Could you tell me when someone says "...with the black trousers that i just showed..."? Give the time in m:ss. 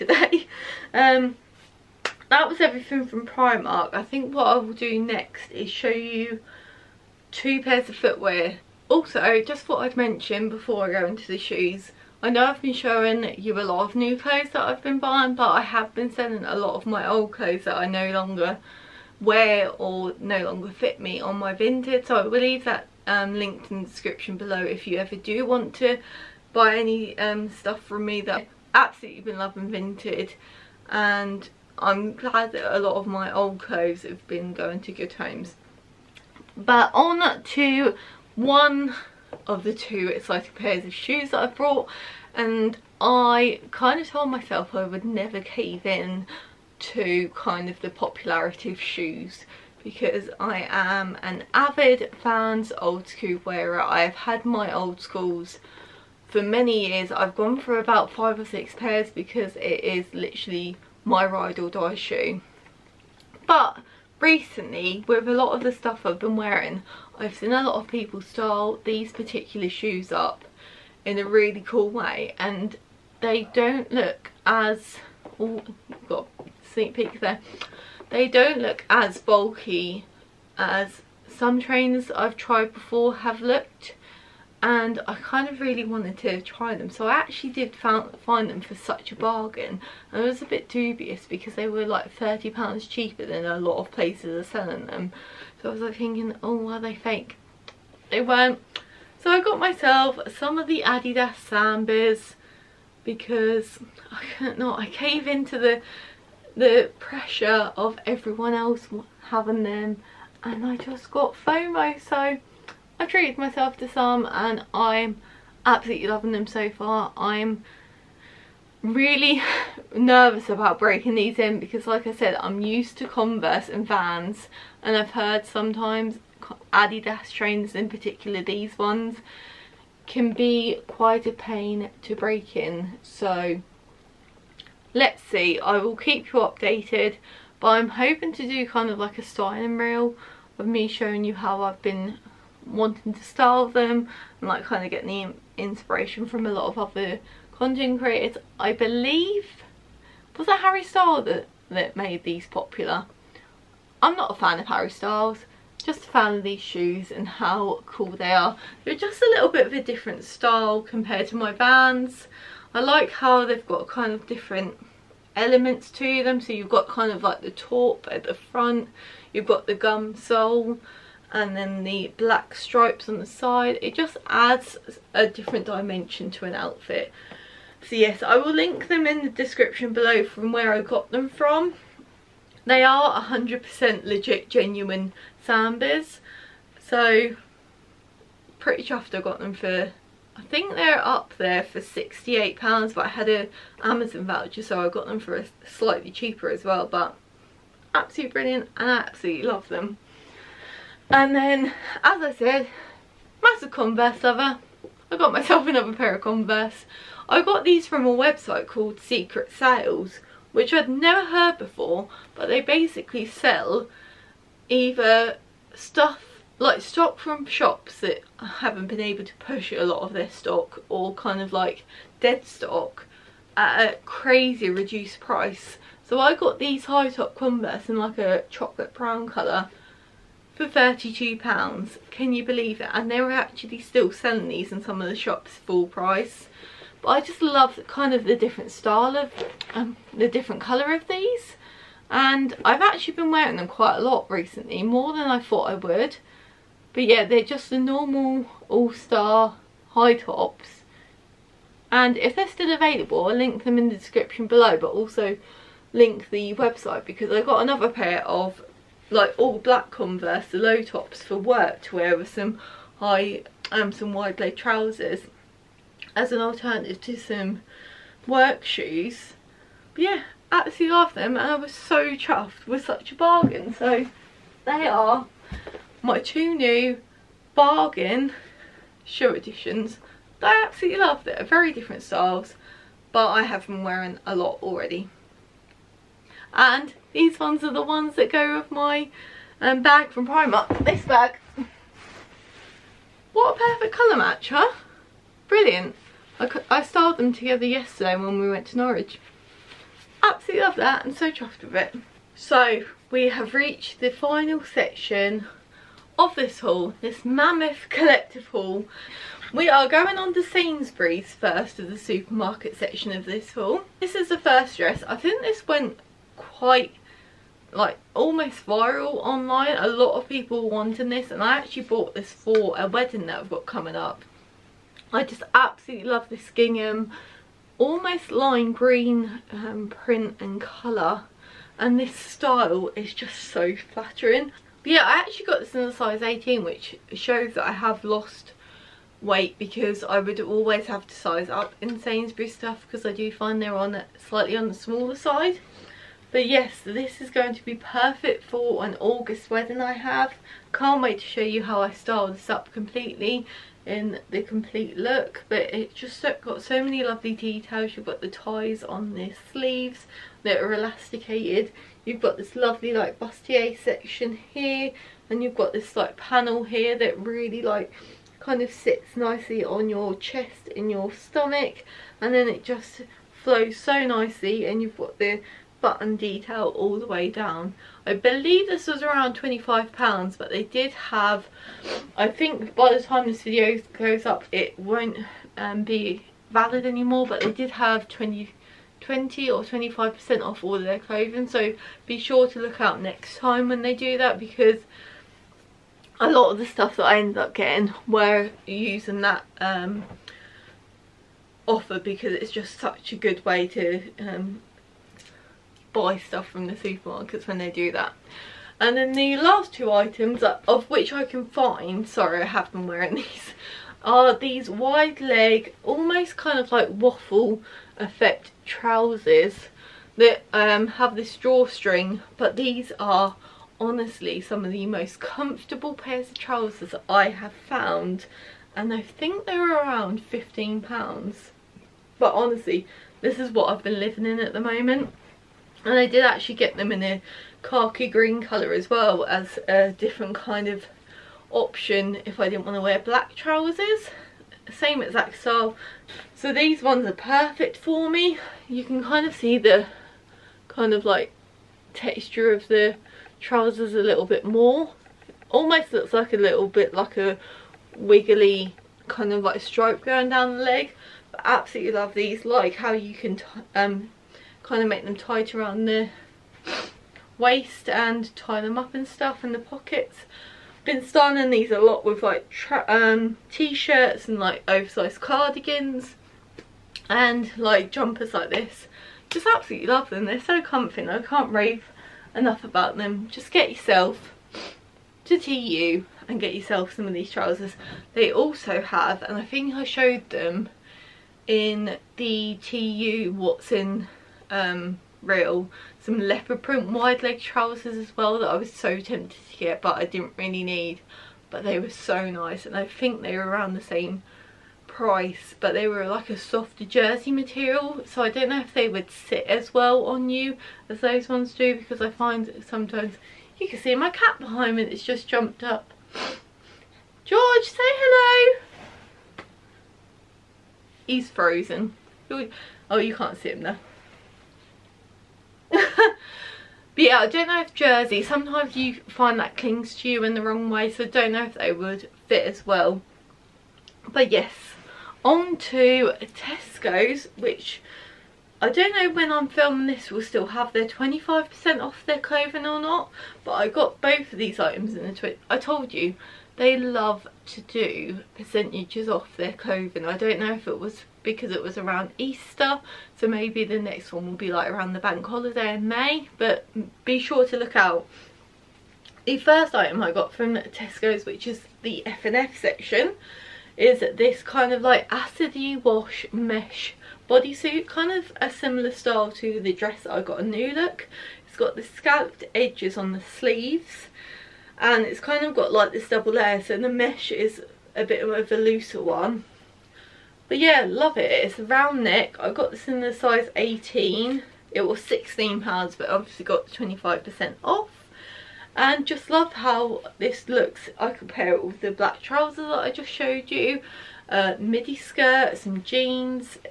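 9:51.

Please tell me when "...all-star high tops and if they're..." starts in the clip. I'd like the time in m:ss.
4:08.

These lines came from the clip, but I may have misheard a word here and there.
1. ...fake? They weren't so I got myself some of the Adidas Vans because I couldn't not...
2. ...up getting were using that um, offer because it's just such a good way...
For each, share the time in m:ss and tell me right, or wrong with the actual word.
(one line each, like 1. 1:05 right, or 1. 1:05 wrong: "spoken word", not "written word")
1. 1:36 wrong: "Sambas", not "Vans"
2. 6:37 right.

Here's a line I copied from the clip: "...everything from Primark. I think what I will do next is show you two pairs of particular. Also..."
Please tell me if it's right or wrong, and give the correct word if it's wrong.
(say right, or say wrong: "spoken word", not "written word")
wrong: "footwear", not "particular".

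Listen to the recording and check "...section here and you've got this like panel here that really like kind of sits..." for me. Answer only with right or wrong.
right.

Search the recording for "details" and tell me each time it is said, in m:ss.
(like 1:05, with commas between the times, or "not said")
5:57, 6:16.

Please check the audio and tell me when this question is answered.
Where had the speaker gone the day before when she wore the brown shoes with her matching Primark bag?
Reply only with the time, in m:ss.
4:58.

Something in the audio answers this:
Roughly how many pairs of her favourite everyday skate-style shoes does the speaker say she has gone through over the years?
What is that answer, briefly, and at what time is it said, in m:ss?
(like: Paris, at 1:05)
5 or 6, at 0:58.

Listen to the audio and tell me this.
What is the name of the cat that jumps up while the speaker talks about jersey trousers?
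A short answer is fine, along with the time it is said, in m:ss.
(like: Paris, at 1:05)
George, at 8:37.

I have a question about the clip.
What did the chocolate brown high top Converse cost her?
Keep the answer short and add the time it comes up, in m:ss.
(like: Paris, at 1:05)
£32, at 3:50.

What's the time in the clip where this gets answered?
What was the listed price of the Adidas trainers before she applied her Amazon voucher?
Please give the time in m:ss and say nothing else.
3:11.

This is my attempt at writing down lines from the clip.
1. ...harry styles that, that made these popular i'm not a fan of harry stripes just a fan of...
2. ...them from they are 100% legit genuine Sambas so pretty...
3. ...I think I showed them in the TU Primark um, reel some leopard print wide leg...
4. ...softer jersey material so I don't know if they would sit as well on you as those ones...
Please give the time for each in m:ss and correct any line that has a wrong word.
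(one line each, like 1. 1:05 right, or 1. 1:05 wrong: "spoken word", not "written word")
1. 2:30 wrong: "styles", not "stripes"
2. 3:01 right
3. 8:09 wrong: "Watson", not "Primark"
4. 8:26 right.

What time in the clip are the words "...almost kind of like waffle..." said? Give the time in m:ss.
6:55.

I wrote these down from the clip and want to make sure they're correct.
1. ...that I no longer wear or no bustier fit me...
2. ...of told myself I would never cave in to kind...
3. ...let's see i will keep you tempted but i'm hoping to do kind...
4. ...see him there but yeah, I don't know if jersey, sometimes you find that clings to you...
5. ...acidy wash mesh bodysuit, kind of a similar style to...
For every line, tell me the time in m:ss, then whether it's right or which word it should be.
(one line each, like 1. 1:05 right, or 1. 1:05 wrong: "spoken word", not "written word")
1. 0:17 wrong: "longer", not "bustier"
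2. 0:43 right
3. 2:14 wrong: "updated", not "tempted"
4. 8:43 right
5. 9:25 right.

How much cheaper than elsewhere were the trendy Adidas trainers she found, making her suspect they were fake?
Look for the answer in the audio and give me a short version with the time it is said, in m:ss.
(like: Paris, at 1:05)
£30, at 1:32.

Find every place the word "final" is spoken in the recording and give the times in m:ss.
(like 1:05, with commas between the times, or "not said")
5:04.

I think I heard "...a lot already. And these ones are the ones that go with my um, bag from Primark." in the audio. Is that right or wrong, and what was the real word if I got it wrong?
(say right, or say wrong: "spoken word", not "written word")
right.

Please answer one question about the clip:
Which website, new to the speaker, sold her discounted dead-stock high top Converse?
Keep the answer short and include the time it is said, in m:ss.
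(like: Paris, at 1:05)
Secret Sales, at 3:28.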